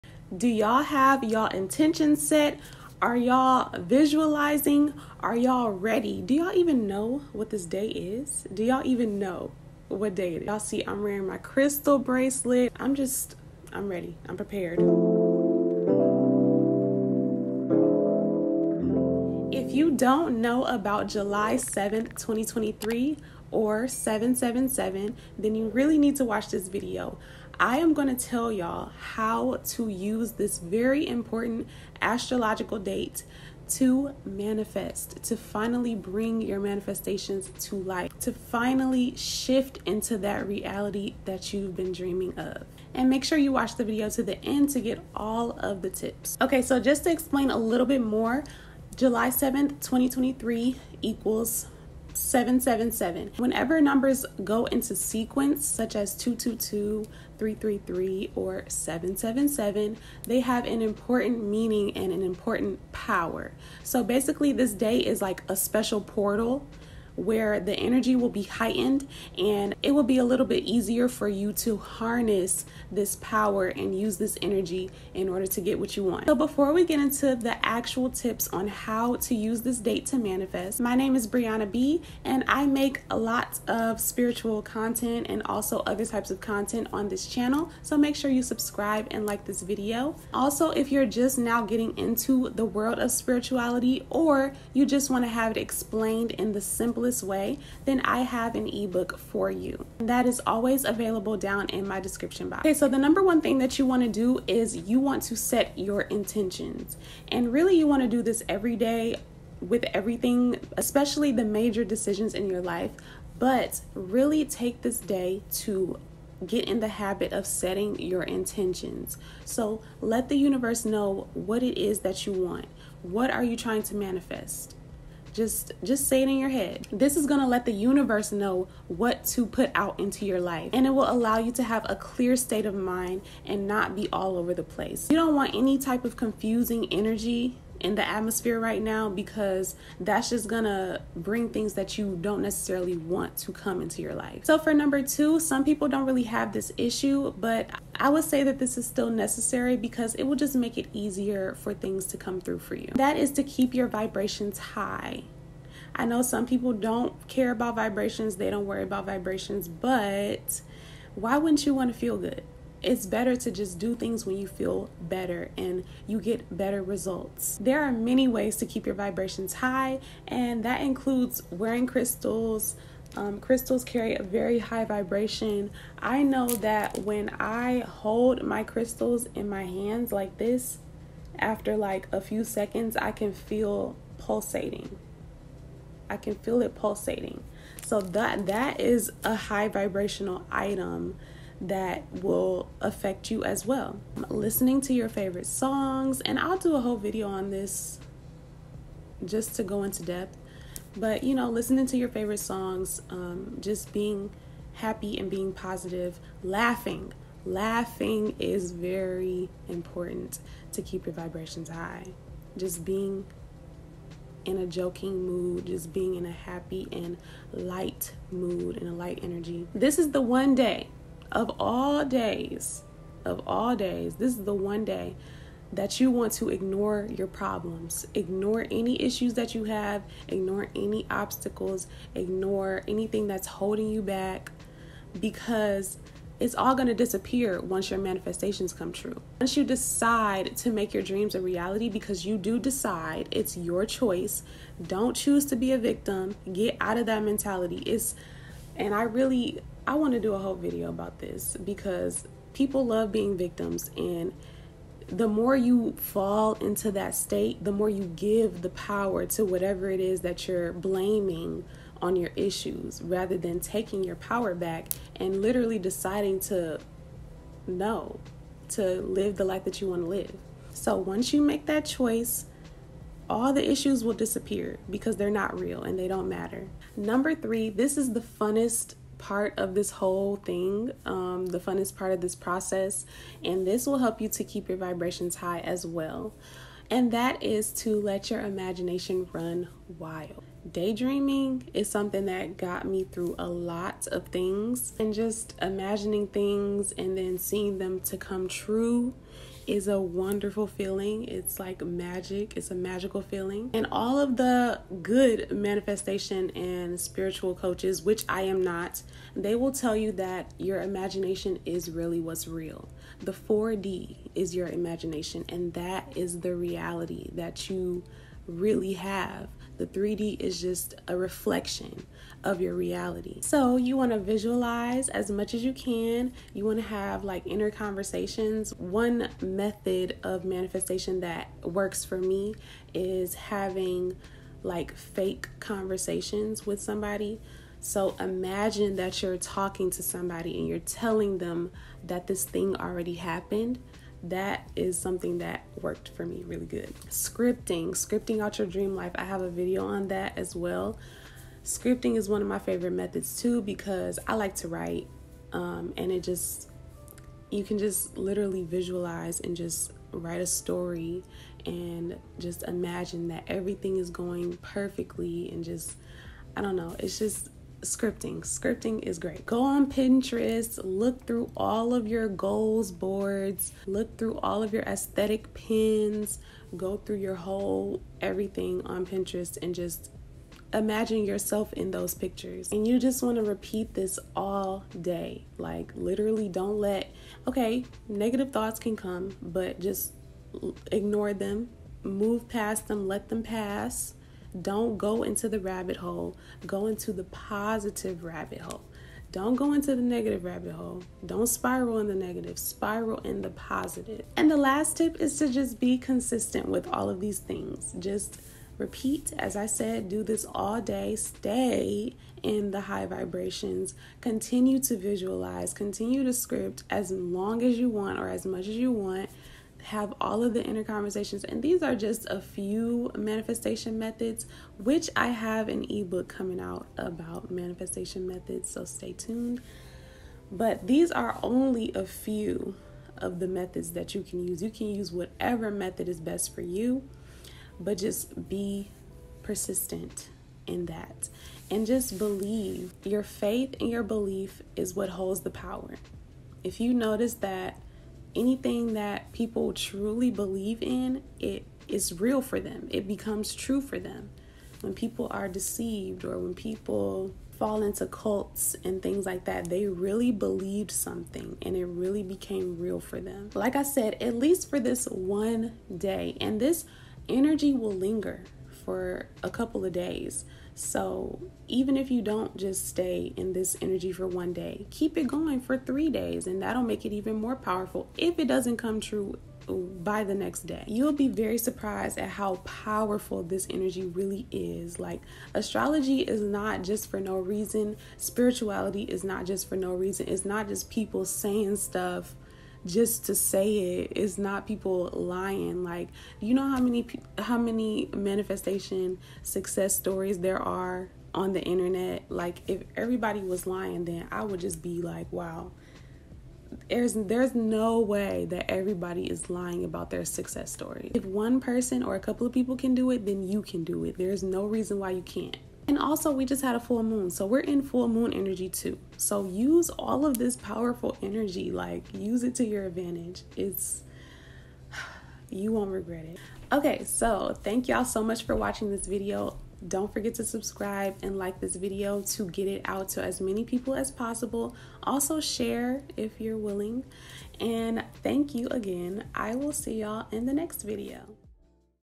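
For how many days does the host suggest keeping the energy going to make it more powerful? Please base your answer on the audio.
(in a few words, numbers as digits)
3.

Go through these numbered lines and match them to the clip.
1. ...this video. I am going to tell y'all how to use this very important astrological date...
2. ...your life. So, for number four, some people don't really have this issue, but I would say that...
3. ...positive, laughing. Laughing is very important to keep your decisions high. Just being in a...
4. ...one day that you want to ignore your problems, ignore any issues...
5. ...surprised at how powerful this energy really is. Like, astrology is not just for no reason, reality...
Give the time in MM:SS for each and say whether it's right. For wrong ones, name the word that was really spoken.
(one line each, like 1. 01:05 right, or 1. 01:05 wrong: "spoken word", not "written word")
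1. 00:26 right
2. 02:24 wrong: "two", not "four"
3. 03:25 wrong: "vibrations", not "decisions"
4. 03:44 right
5. 08:01 wrong: "spirituality", not "reality".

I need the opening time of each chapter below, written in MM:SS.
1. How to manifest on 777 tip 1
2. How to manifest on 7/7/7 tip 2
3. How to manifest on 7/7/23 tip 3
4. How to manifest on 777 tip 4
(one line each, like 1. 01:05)
1. 01:42
2. 02:32
3. 04:36
4. 06:43.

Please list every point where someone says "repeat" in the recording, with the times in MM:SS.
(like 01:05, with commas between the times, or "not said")
06:23, 06:48.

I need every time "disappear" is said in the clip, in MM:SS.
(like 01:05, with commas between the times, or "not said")
03:56, 04:34.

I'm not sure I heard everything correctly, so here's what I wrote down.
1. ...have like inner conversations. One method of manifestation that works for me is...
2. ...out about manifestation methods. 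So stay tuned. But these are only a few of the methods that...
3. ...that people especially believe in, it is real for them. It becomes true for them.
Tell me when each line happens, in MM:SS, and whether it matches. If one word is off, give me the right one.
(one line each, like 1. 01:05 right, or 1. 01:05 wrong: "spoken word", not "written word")
1. 05:26 right
2. 07:06 right
3. 07:28 wrong: "truly", not "especially".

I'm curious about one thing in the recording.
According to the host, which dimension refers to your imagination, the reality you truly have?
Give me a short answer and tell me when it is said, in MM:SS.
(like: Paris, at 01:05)
4D, at 05:13.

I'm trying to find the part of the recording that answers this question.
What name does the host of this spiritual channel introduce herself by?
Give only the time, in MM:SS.
01:21.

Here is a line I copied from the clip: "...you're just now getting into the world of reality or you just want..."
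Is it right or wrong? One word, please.
wrong.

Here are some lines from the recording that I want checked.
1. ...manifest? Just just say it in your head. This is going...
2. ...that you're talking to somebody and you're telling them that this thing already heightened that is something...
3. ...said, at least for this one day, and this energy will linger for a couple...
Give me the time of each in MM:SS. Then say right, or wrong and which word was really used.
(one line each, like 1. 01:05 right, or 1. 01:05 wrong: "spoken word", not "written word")
1. 02:03 right
2. 05:38 wrong: "happened", not "heightened"
3. 07:43 right.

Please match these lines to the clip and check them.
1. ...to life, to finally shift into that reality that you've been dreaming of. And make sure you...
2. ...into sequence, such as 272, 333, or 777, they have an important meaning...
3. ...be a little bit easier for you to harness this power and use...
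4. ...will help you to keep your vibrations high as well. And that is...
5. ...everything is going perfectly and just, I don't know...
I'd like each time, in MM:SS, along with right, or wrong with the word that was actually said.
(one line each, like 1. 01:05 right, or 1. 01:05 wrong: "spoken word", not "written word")
1. 00:37 right
2. 00:54 wrong: "222", not "272"
3. 01:10 right
4. 04:43 right
5. 06:03 right.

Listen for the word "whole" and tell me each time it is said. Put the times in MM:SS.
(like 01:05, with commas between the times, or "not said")
03:16, 04:10, 04:39, 06:17.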